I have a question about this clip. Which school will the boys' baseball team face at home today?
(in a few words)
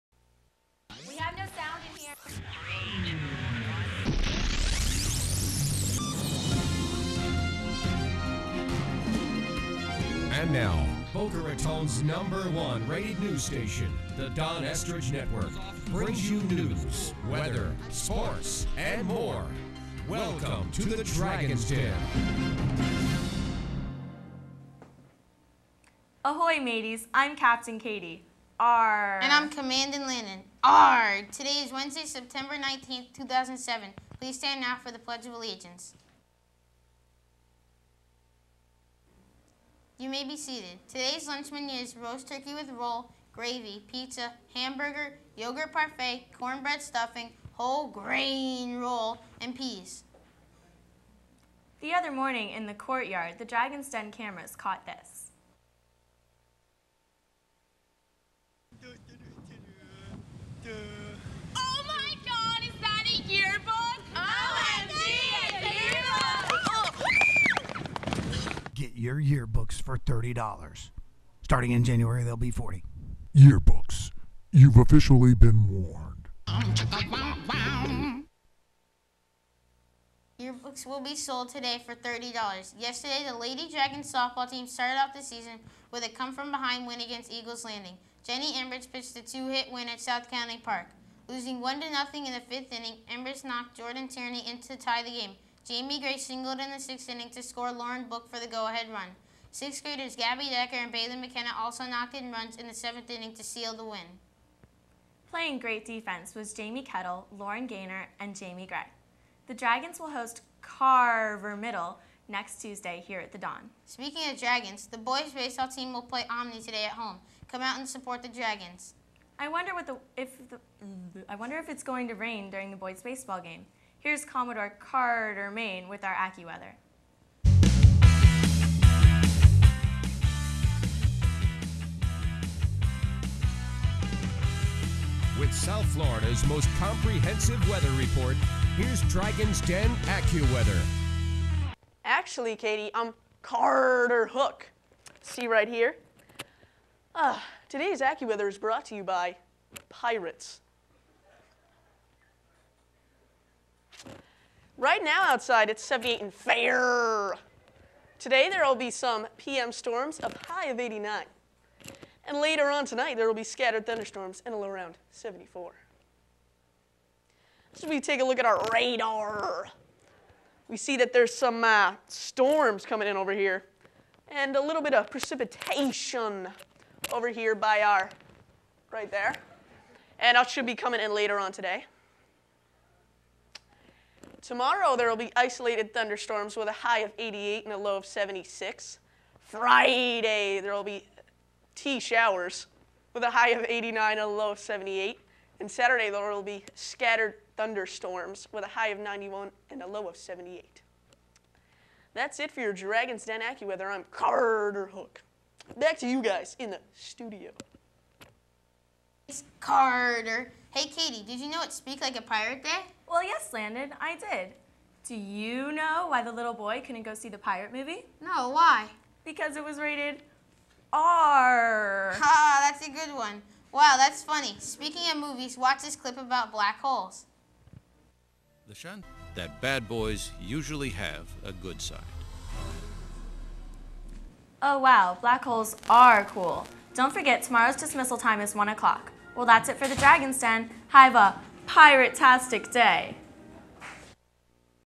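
Omni.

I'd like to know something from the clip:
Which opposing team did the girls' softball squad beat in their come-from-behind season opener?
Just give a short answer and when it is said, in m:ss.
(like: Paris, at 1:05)
Eagles Landing, at 1:27.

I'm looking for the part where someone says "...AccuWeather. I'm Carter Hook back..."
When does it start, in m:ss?
3:23.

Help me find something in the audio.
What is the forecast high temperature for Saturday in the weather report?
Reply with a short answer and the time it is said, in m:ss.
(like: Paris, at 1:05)
91, at 3:18.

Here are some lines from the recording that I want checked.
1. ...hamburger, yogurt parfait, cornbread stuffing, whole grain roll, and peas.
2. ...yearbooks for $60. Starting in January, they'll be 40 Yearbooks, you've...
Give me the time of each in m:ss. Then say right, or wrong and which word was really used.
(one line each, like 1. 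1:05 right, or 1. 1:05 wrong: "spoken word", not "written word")
1. 0:44 right
2. 1:09 wrong: "30", not "60".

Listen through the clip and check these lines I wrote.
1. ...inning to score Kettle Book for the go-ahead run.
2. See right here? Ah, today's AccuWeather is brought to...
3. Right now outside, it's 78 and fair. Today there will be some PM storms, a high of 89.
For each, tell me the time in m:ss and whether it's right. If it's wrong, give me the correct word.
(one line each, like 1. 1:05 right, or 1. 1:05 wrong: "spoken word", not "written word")
1. 1:37 wrong: "Lauren", not "Kettle"
2. 2:25 right
3. 2:34 right.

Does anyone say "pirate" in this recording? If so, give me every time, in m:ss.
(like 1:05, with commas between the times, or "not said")
2:29, 3:32, 3:37, 4:01.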